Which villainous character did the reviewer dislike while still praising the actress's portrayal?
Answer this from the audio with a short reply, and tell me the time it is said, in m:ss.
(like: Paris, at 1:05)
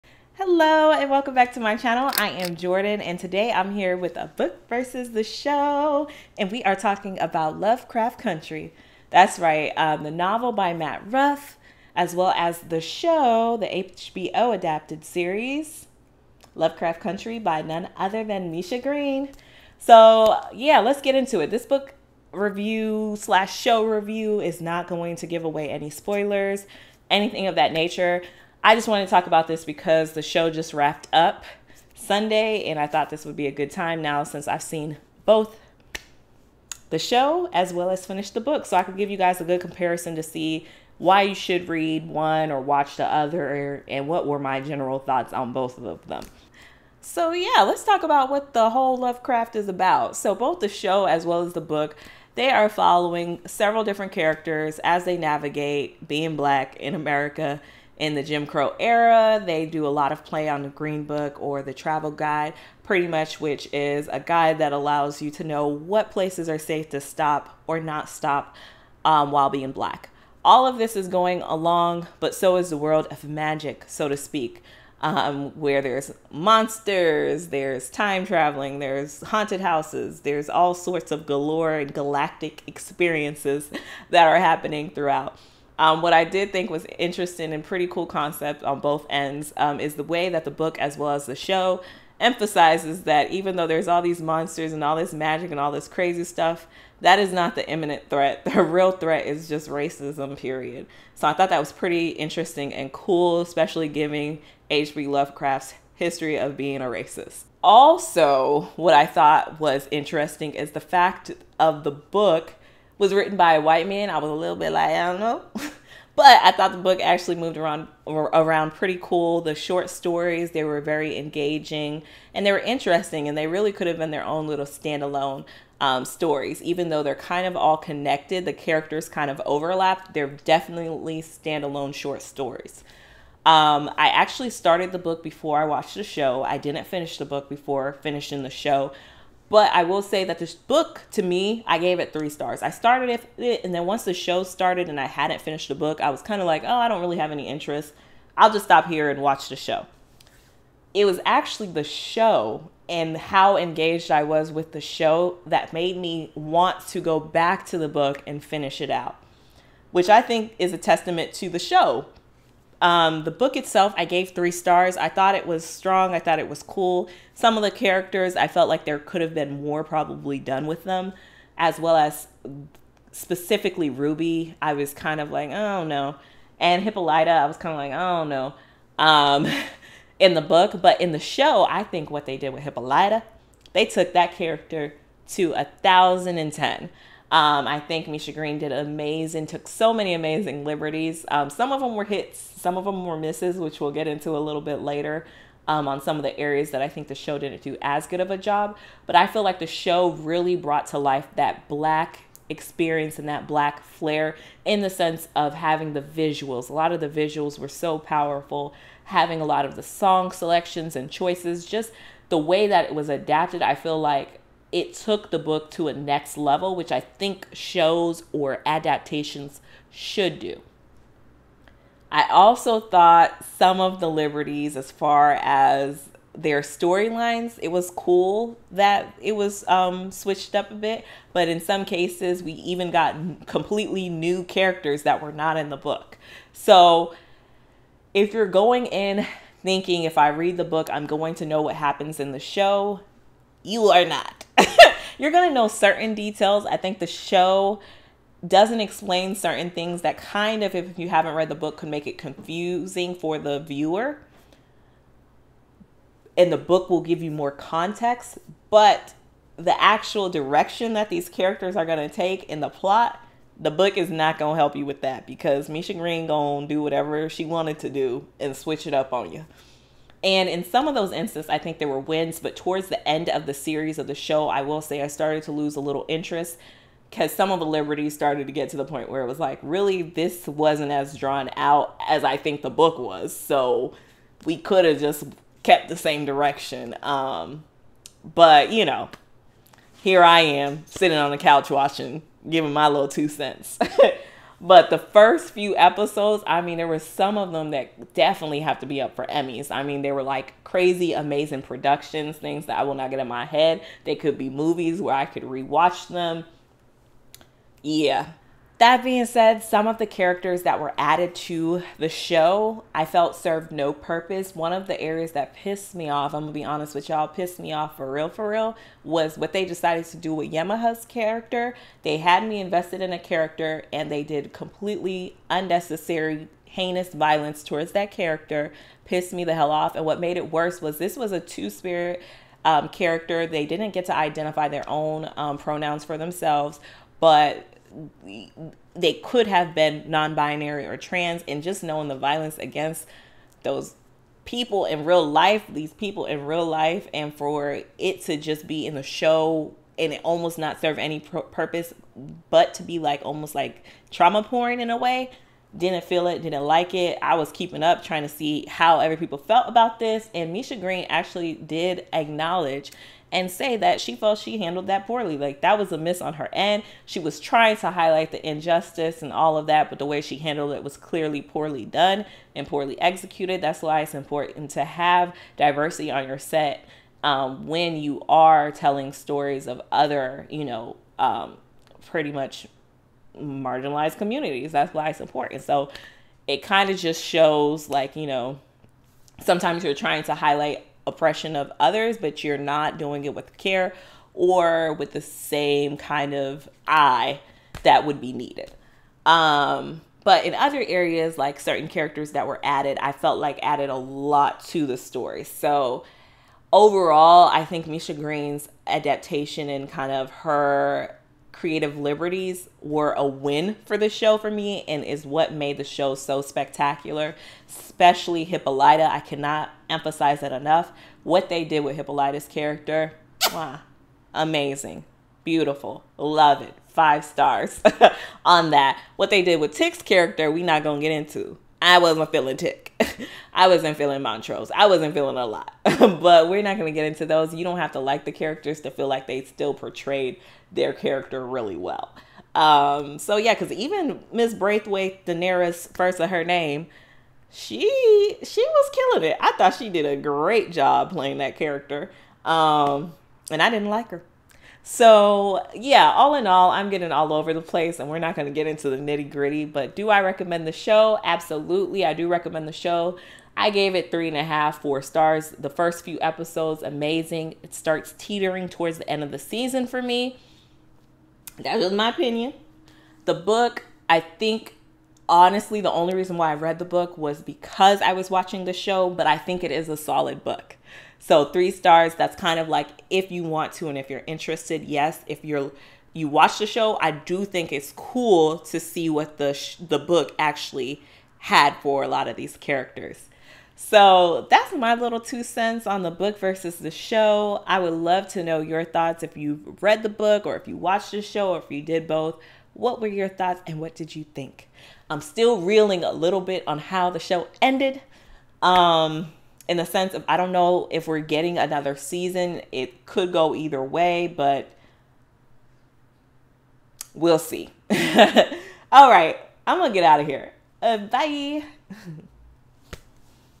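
Miss Braithwhite, at 7:24.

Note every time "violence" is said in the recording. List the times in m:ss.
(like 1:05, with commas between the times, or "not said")
5:27, 5:42.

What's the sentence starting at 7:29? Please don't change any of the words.
I thought she did a great job playing that character.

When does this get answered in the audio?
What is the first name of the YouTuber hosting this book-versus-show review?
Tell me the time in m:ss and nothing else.
0:02.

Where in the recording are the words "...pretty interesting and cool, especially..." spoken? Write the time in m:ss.
1:41.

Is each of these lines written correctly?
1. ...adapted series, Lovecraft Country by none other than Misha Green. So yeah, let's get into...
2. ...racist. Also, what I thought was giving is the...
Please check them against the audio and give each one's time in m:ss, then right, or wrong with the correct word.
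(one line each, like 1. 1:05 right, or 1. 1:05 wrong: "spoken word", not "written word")
1. 0:14 right
2. 1:46 wrong: "interesting", not "giving".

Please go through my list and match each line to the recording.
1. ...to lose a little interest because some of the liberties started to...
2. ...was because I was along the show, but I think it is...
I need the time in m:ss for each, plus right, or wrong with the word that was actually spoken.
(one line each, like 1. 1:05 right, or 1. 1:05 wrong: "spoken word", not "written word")
1. 4:35 right
2. 7:57 wrong: "watching", not "along".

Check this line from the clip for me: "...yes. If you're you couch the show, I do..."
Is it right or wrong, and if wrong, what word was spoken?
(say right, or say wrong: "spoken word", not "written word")
wrong: "watch", not "couch".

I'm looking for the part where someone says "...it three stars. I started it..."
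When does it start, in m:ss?
2:21.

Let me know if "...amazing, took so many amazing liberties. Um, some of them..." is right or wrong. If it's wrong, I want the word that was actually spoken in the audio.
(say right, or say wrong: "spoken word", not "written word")
right.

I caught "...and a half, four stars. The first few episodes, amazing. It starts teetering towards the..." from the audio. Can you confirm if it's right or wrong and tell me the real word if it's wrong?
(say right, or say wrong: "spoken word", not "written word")
right.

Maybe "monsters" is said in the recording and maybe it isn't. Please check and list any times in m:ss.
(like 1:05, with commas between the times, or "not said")
1:16, 1:34.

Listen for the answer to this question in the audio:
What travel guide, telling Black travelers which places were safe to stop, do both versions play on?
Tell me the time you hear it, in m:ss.
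1:00.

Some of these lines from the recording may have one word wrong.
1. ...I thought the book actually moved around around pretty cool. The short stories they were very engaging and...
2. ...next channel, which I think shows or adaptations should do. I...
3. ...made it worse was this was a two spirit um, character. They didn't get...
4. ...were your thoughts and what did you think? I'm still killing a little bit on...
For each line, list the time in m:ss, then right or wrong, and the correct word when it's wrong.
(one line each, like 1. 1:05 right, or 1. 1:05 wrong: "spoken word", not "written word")
1. 1:56 right
2. 3:35 wrong: "level", not "channel"
3. 5:30 right
4. 8:22 wrong: "reeling", not "killing".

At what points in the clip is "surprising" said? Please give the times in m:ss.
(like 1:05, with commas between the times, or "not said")
not said.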